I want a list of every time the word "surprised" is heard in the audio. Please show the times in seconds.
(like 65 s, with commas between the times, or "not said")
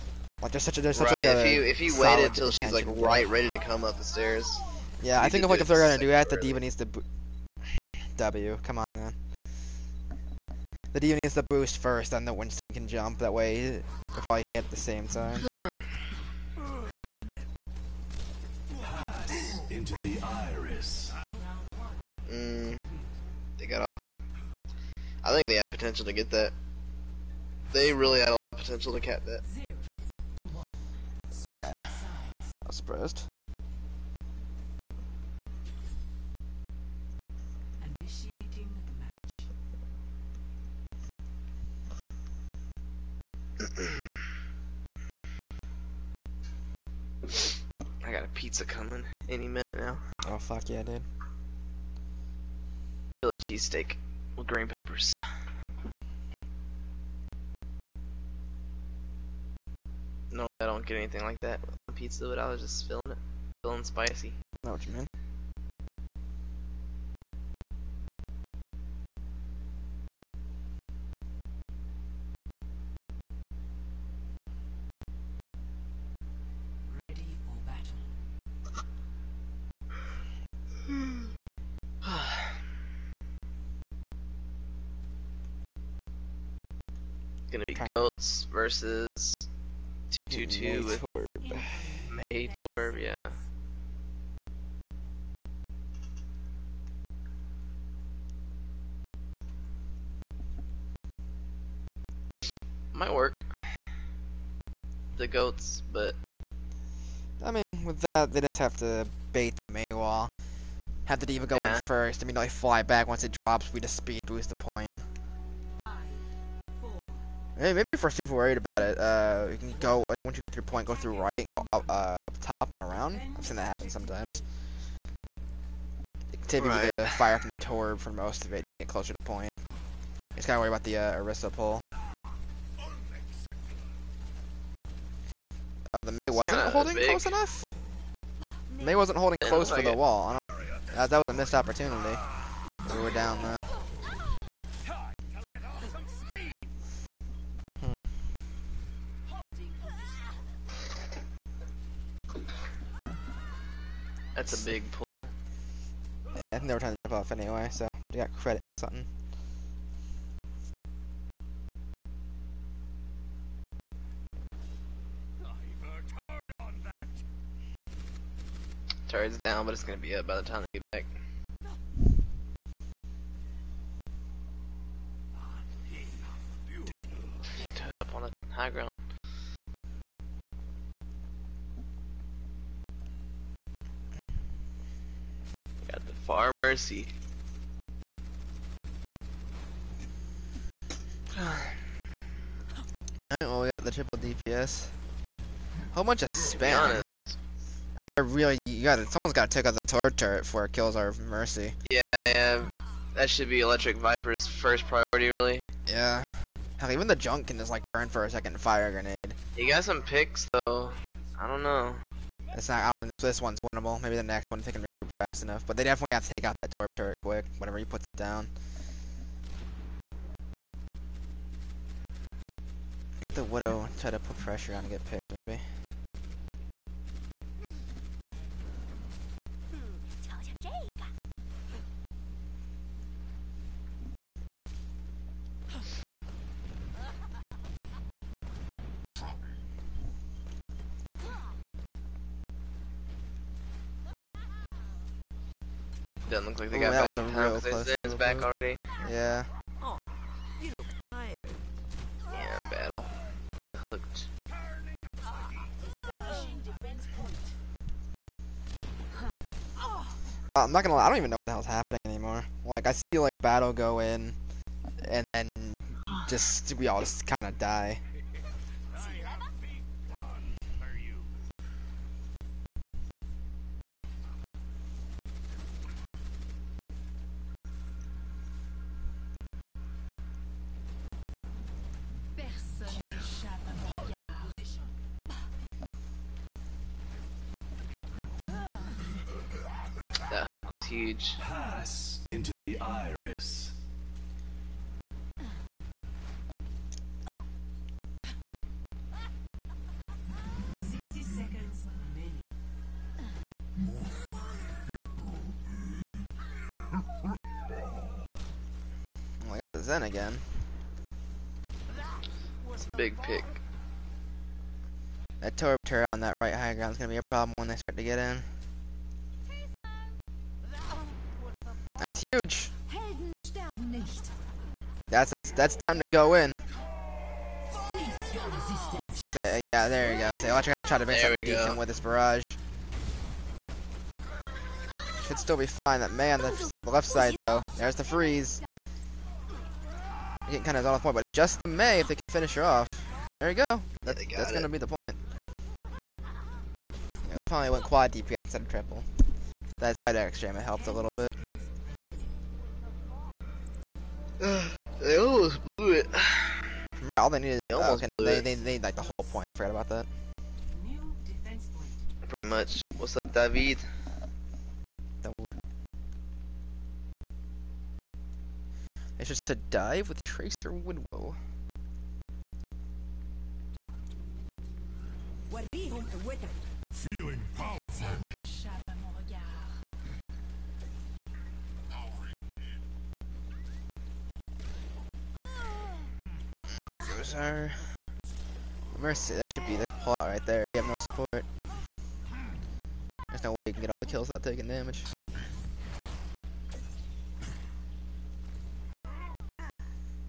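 32 s.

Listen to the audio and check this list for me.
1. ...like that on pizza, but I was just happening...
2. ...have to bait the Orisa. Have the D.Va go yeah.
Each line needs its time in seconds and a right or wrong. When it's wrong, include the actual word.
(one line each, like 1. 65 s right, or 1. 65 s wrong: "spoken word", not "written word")
1. 61 s wrong: "feeling", not "happening"
2. 108 s wrong: "Maywall", not "Orisa".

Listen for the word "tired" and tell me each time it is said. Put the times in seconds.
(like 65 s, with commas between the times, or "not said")
251 s.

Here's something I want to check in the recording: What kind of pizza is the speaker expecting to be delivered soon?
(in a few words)
Philly cheesesteak.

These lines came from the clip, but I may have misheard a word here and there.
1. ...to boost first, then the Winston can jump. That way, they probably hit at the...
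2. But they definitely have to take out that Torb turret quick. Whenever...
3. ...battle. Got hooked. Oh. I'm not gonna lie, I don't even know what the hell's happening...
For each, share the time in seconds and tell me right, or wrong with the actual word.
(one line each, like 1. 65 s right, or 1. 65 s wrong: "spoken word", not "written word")
1. 11 s right
2. 215 s right
3. 252 s right.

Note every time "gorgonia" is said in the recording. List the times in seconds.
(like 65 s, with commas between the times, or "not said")
not said.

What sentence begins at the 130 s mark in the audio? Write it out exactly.
just gotta worry about the, uh, Orisa pull.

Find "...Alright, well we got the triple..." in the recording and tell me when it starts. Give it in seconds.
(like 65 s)
191 s.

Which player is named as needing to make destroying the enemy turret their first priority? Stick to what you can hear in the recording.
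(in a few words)
Electric Viper.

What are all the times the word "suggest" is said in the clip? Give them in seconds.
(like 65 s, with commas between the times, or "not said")
not said.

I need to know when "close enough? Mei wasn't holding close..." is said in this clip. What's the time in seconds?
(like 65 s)
137 s.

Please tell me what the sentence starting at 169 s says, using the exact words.
Turret's down, but it's gonna be up by the time they get back.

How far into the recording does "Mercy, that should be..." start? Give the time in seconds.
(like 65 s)
388 s.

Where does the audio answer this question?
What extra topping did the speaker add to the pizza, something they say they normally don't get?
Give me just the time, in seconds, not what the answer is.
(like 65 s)
54 s.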